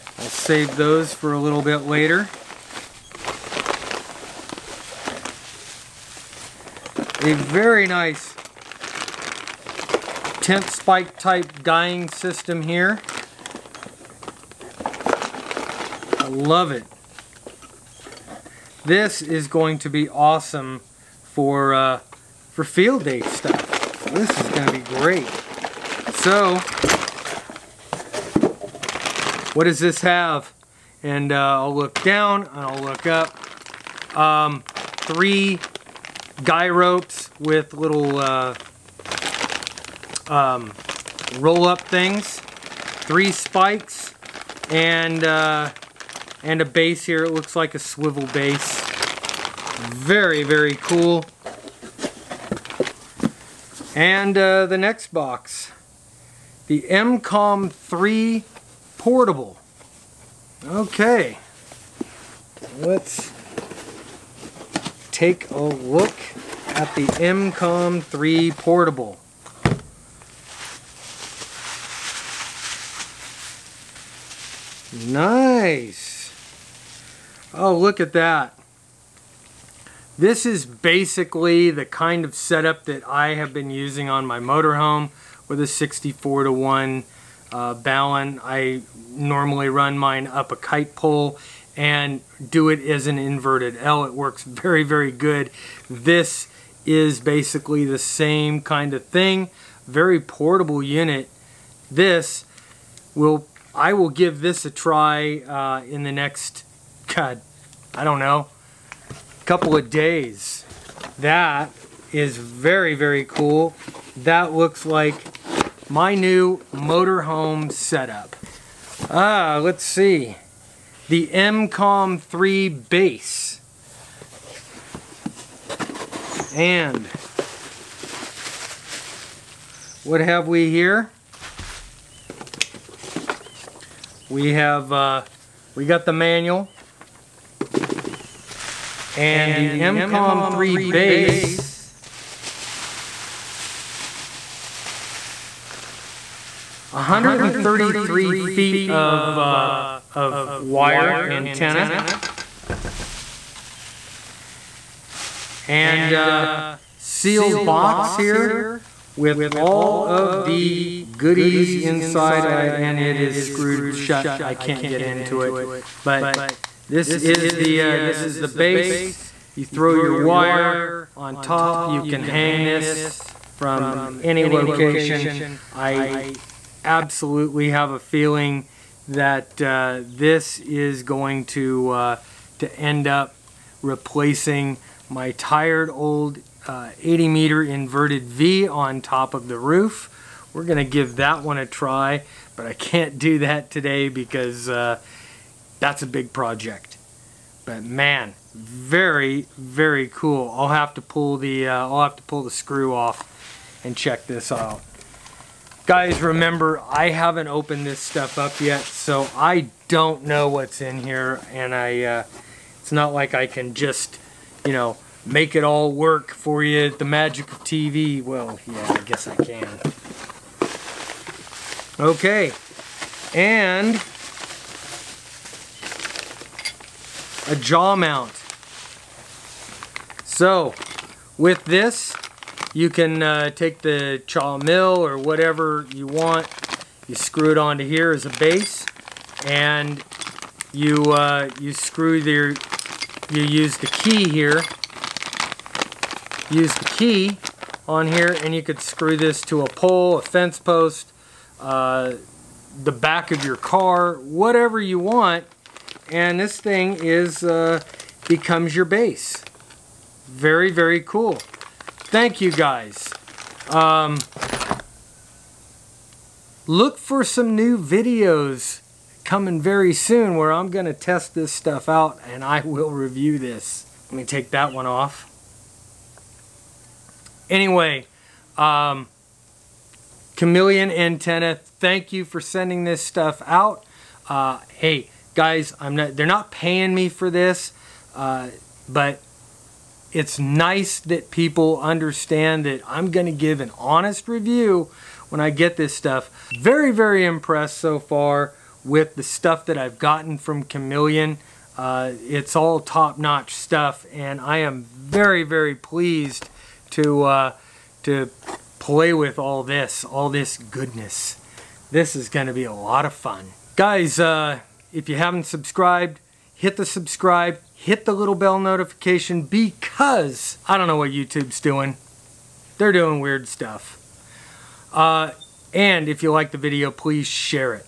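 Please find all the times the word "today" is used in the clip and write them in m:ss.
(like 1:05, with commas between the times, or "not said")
3:13.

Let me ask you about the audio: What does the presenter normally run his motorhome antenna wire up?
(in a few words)
A kite pole.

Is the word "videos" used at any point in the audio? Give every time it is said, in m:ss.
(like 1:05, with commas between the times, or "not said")
4:27, 5:26.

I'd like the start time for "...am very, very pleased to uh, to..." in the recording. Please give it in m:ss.
5:04.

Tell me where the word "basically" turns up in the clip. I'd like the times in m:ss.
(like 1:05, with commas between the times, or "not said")
1:20, 1:37.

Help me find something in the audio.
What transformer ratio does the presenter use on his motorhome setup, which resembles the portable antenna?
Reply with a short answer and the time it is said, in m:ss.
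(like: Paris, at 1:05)
64 to 1, at 1:25.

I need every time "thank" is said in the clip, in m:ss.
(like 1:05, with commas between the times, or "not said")
4:22, 4:41.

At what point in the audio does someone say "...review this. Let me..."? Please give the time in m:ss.
4:32.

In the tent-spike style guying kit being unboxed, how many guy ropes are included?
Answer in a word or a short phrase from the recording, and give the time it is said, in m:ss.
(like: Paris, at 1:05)
3, at 0:34.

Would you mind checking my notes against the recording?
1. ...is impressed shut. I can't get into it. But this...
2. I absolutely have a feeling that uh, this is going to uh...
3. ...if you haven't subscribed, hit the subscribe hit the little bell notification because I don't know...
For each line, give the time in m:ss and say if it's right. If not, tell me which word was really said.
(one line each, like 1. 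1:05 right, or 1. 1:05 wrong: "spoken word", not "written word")
1. 2:43 wrong: "screwed", not "impressed"
2. 2:55 right
3. 5:14 right.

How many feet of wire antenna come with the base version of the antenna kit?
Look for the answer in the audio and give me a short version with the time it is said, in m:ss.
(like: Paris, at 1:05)
133 feet, at 2:26.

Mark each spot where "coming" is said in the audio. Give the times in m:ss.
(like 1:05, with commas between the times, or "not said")
4:29.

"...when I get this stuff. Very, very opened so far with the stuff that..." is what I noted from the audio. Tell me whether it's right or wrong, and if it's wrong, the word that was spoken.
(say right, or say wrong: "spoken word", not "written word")
wrong: "impressed", not "opened".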